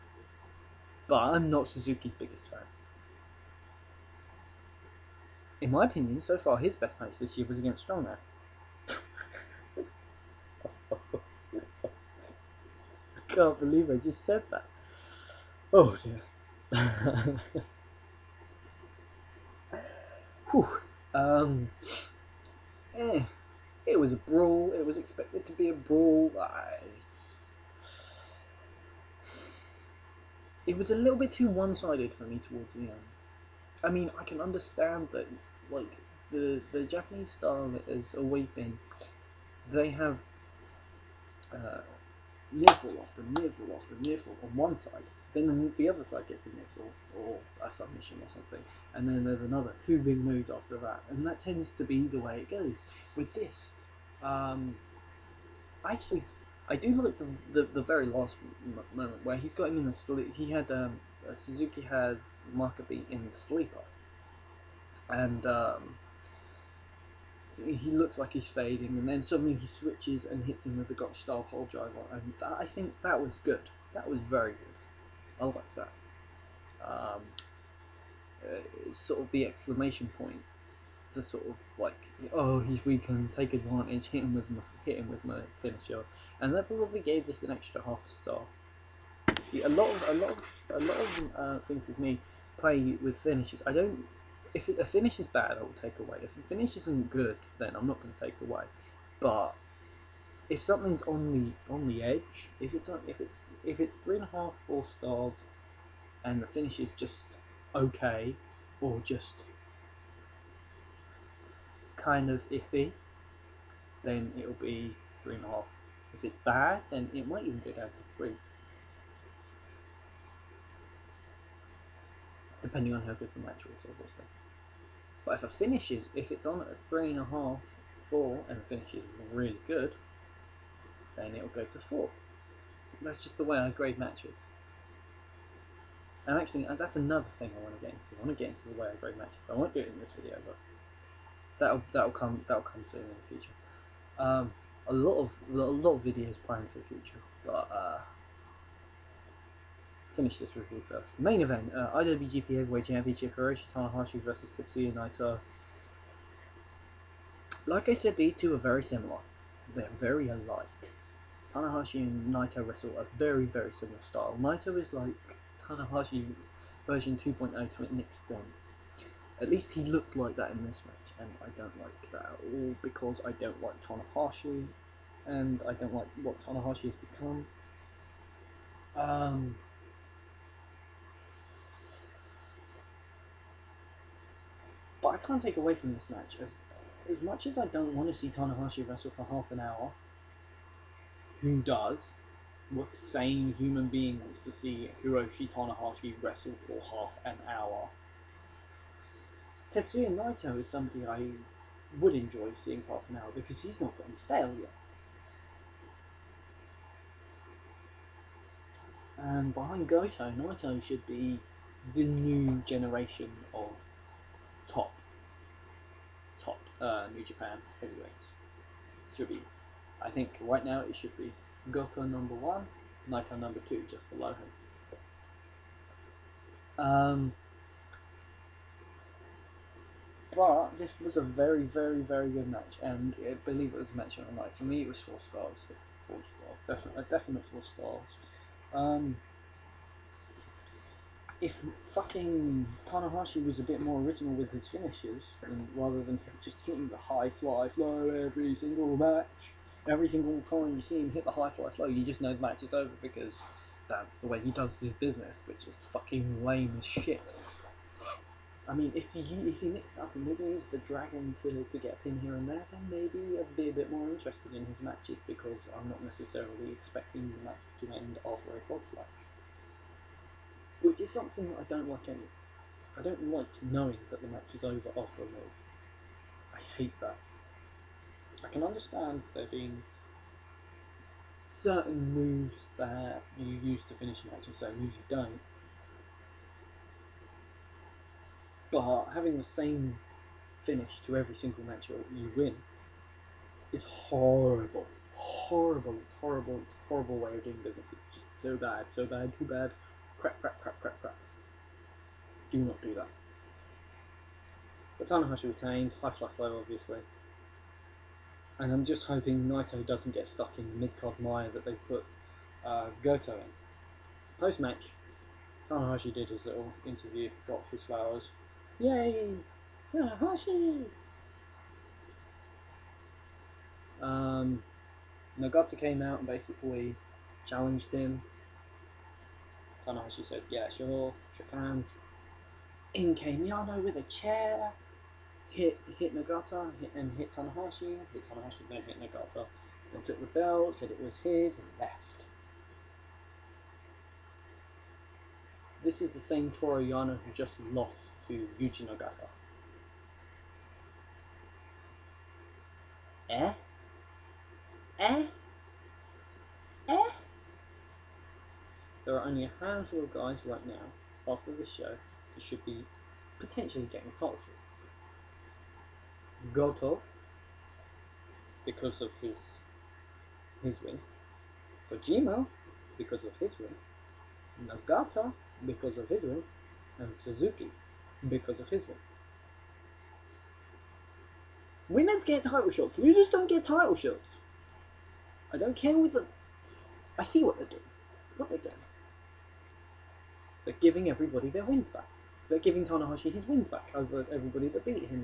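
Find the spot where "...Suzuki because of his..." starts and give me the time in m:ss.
6:17.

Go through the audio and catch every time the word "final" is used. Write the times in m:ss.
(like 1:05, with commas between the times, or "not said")
not said.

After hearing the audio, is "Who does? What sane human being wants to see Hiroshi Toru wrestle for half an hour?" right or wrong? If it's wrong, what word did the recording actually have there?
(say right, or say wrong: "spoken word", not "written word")
wrong: "Tanahashi", not "Toru".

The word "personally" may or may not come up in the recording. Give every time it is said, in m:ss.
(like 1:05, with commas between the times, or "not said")
not said.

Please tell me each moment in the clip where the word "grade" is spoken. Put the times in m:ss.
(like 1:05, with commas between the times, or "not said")
2:13, 2:18.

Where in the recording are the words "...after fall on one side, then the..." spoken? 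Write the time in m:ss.
0:43.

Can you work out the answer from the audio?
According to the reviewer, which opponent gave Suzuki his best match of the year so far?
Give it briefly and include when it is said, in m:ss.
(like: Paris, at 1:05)
Strongman, at 0:07.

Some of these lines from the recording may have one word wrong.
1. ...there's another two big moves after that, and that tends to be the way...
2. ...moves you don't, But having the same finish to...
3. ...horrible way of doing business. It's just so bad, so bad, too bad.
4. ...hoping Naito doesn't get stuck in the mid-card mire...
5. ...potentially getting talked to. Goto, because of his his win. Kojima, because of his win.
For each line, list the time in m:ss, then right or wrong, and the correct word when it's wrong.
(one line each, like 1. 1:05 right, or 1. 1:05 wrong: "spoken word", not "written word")
1. 0:49 right
2. 4:44 right
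3. 4:56 right
4. 5:09 right
5. 6:03 right.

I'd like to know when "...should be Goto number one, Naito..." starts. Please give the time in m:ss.
3:40.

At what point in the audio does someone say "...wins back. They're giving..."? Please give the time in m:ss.
6:31.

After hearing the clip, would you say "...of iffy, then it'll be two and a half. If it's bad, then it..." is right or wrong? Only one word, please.
wrong.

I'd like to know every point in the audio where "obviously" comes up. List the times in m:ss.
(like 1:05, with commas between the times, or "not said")
2:03, 5:06.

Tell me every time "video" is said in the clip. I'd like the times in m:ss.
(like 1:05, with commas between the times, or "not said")
2:20, 2:26.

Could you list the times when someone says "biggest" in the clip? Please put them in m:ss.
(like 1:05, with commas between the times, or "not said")
0:02.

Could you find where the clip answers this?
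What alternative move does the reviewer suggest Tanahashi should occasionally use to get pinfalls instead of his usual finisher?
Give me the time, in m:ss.
4:20.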